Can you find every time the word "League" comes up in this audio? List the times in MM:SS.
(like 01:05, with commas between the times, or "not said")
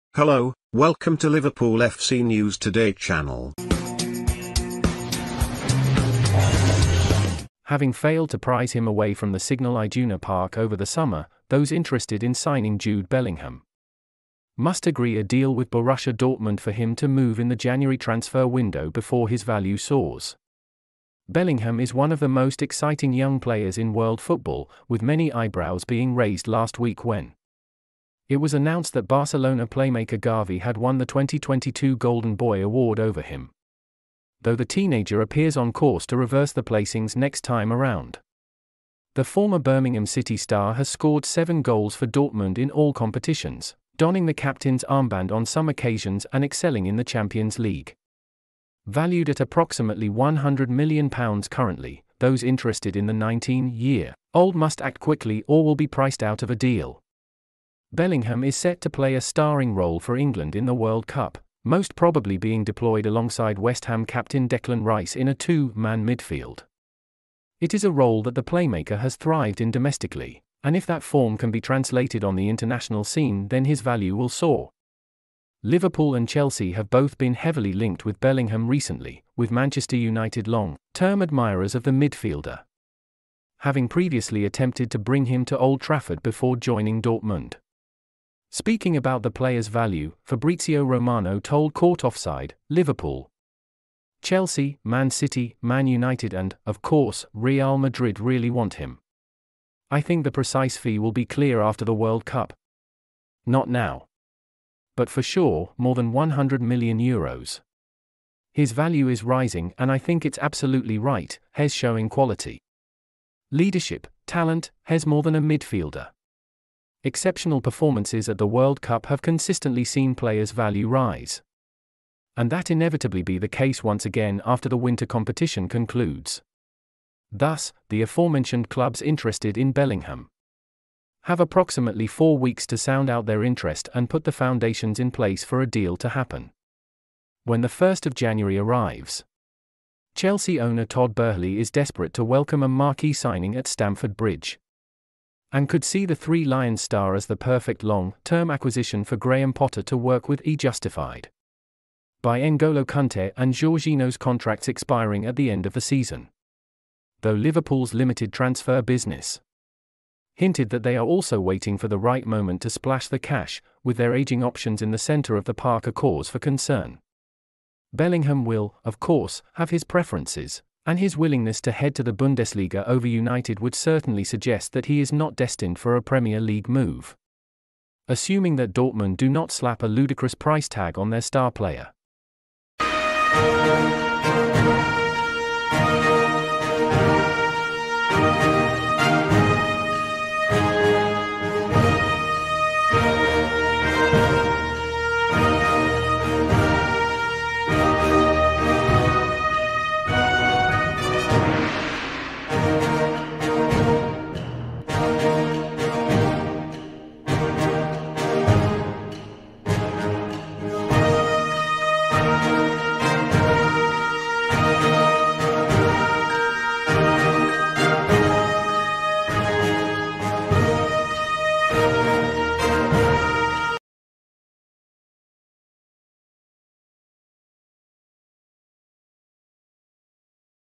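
00:47, 02:56.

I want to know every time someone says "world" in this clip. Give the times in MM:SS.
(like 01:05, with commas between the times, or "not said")
00:23, 01:00, 01:41, 01:58.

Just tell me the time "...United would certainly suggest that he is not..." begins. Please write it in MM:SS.
02:53.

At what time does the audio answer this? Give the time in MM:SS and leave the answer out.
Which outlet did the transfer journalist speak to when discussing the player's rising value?
01:31.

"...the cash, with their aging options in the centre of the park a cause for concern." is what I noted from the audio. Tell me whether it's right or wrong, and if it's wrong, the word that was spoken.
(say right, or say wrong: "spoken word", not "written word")
right.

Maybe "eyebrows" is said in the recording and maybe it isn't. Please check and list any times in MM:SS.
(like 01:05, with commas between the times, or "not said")
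00:25.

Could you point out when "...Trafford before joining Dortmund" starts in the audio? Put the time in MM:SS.
01:25.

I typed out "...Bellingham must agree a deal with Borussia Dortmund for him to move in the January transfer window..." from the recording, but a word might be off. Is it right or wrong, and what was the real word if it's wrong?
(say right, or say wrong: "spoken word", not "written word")
right.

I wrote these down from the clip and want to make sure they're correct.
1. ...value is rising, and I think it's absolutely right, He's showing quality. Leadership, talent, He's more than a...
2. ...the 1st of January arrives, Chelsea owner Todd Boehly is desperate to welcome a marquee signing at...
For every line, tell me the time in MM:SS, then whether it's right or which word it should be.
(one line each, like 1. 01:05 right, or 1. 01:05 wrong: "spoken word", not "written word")
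1. 01:48 right
2. 02:17 right.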